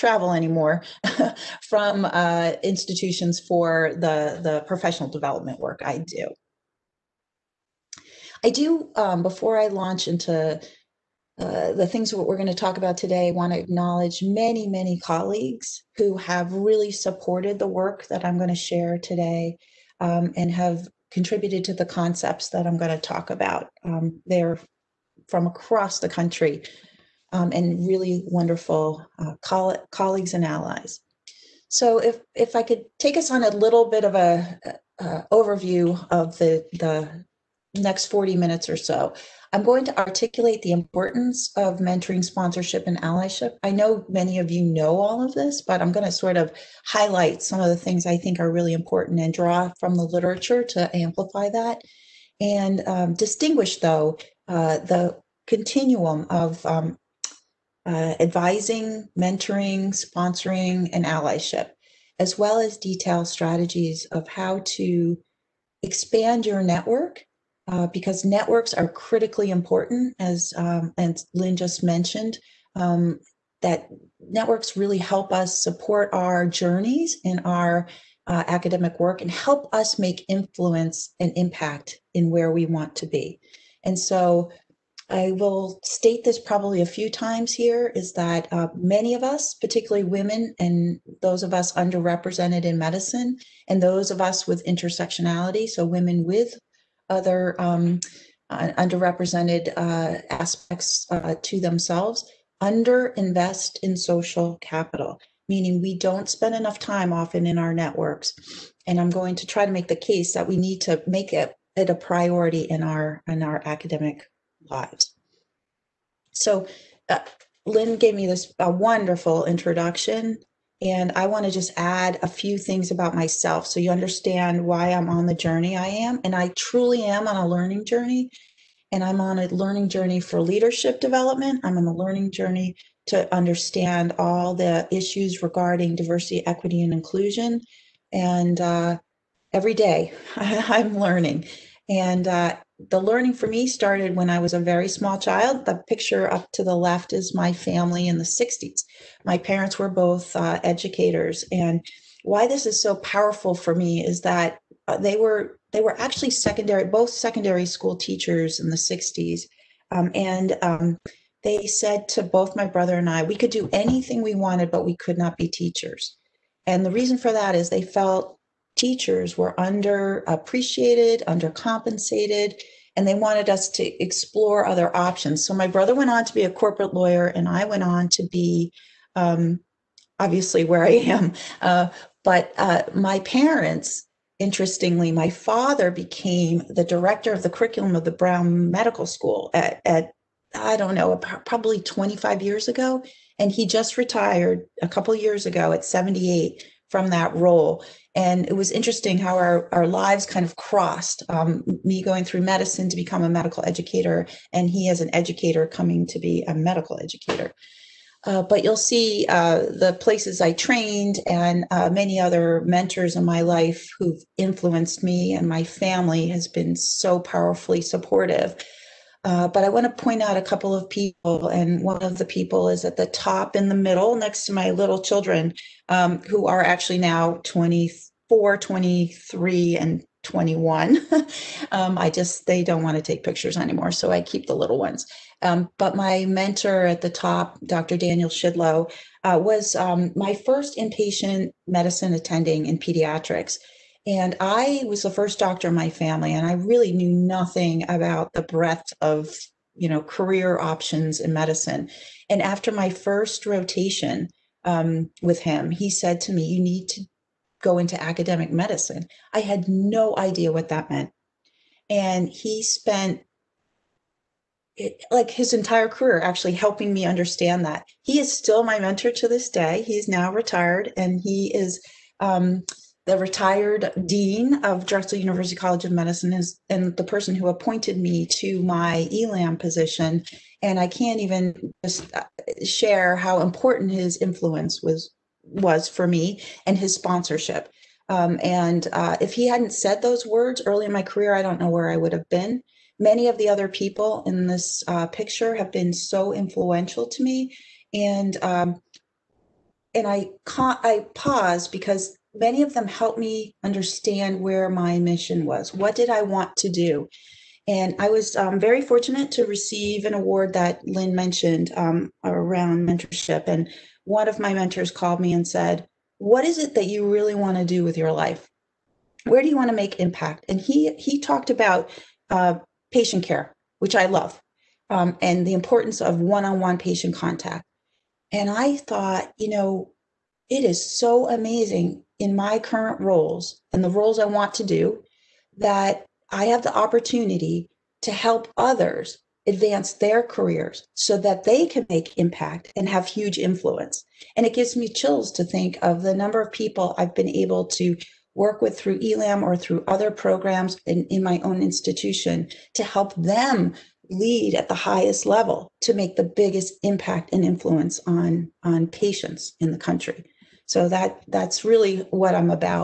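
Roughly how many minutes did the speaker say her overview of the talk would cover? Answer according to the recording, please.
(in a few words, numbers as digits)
40.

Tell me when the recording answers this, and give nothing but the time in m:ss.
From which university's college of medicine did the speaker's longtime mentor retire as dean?
4:34.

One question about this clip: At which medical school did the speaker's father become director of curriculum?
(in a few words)
Brown Medical School.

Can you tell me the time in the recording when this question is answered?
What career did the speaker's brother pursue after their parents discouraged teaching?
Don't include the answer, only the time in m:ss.
2:56.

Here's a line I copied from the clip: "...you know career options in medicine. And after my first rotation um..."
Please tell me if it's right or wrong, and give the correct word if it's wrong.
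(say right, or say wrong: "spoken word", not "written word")
right.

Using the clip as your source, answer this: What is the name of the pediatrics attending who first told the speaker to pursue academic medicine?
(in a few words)
Dr. Daniel Schidlow.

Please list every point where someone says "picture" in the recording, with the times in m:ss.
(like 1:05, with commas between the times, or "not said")
2:25, 3:53, 4:55.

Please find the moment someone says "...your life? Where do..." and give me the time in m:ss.
5:17.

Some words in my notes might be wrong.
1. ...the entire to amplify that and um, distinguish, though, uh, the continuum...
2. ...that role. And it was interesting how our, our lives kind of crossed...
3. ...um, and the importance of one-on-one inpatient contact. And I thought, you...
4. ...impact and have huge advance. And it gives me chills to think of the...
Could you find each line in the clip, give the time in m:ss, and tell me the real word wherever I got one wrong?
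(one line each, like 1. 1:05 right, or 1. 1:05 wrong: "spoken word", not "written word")
1. 0:49 wrong: "literature", not "entire"
2. 3:17 right
3. 5:24 wrong: "patient", not "inpatient"
4. 5:42 wrong: "influence", not "advance".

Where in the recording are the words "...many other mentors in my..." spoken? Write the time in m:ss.
3:31.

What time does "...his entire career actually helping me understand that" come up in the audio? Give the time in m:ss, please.
4:25.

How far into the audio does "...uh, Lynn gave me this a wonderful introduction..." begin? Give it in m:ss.
1:57.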